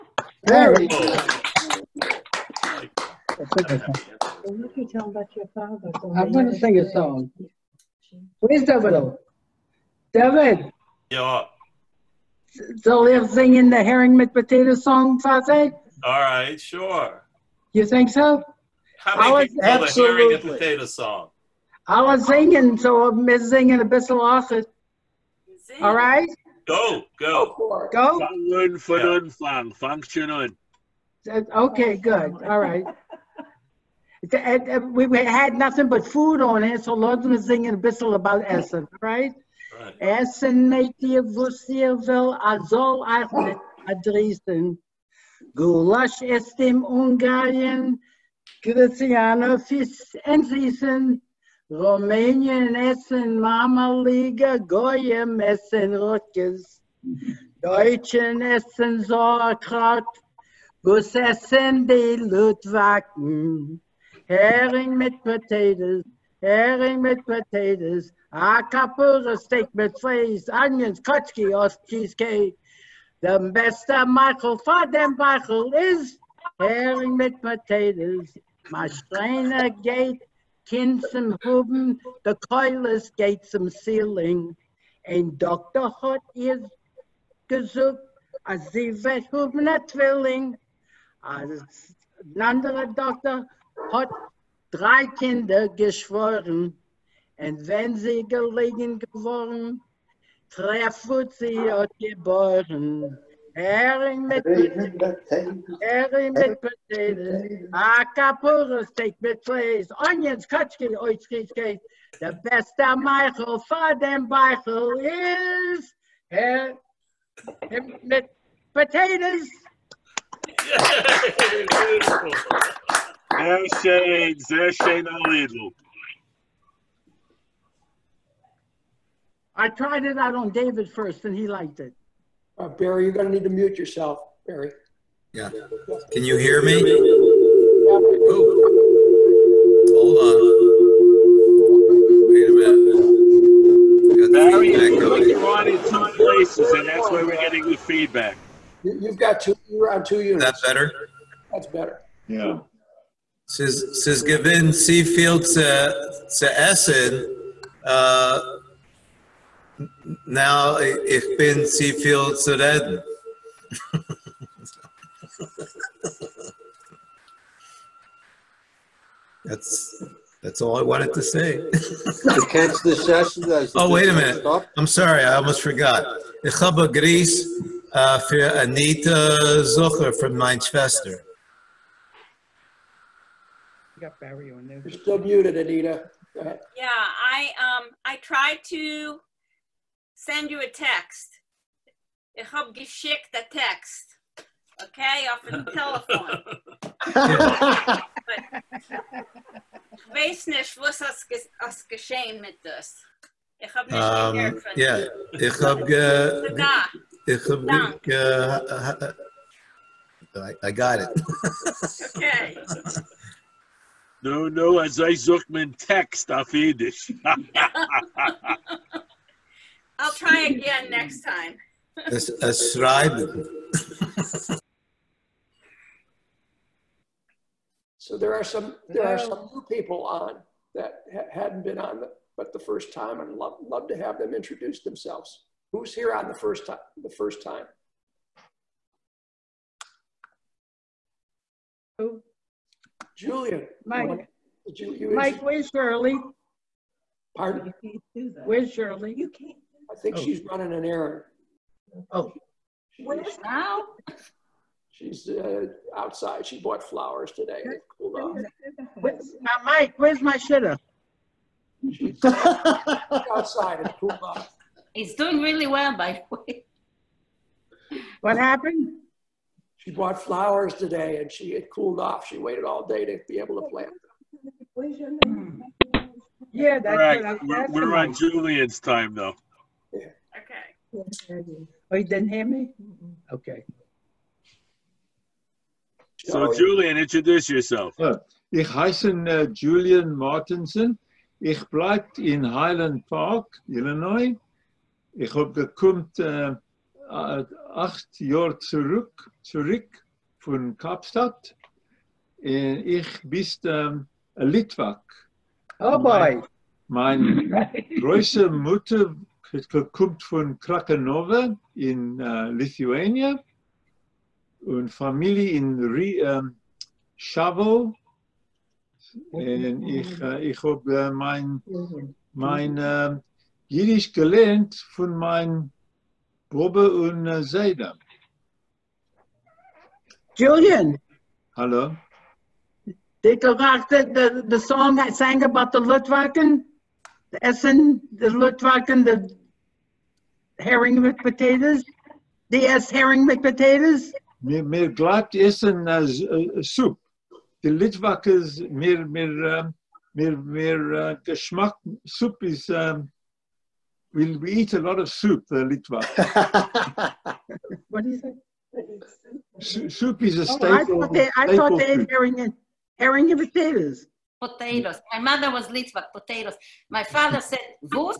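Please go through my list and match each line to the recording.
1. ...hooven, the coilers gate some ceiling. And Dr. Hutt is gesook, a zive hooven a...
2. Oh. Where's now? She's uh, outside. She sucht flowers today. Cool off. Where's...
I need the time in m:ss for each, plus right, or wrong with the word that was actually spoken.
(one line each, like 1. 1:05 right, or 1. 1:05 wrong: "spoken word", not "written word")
1. 1:21 right
2. 4:12 wrong: "bought", not "sucht".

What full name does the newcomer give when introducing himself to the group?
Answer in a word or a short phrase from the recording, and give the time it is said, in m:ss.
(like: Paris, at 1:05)
Julian Martinson, at 4:49.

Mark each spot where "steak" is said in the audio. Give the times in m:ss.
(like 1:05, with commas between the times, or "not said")
1:09, 1:48.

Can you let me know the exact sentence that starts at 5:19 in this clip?
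Äh, ich äh, ich habe äh, mein, mein äh, Jiddisch gelernt von meinem Bobbe und äh, Seida.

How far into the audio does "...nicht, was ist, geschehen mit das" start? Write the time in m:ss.
3:20.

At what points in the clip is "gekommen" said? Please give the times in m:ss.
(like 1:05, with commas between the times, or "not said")
4:55, 5:09.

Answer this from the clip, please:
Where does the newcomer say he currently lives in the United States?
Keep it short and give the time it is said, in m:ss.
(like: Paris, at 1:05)
Highland Park, Illinois, at 4:52.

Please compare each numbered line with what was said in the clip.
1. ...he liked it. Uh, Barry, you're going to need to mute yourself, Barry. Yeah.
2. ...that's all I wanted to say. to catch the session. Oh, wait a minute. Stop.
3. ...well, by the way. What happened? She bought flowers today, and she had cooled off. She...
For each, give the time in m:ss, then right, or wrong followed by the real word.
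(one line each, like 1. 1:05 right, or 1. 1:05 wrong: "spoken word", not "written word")
1. 2:11 right
2. 2:50 right
3. 4:25 right.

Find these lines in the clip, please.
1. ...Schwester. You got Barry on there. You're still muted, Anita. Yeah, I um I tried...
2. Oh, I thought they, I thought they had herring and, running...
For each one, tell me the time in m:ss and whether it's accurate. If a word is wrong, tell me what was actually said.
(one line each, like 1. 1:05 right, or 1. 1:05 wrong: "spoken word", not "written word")
1. 3:00 right
2. 6:00 wrong: "herring", not "running".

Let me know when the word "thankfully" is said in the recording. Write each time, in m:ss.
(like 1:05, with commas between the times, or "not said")
not said.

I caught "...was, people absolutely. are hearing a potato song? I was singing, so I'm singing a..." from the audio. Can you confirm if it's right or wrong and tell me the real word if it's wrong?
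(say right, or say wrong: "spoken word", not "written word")
right.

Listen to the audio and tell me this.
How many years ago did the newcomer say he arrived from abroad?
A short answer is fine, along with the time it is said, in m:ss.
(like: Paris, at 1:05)
8, at 4:57.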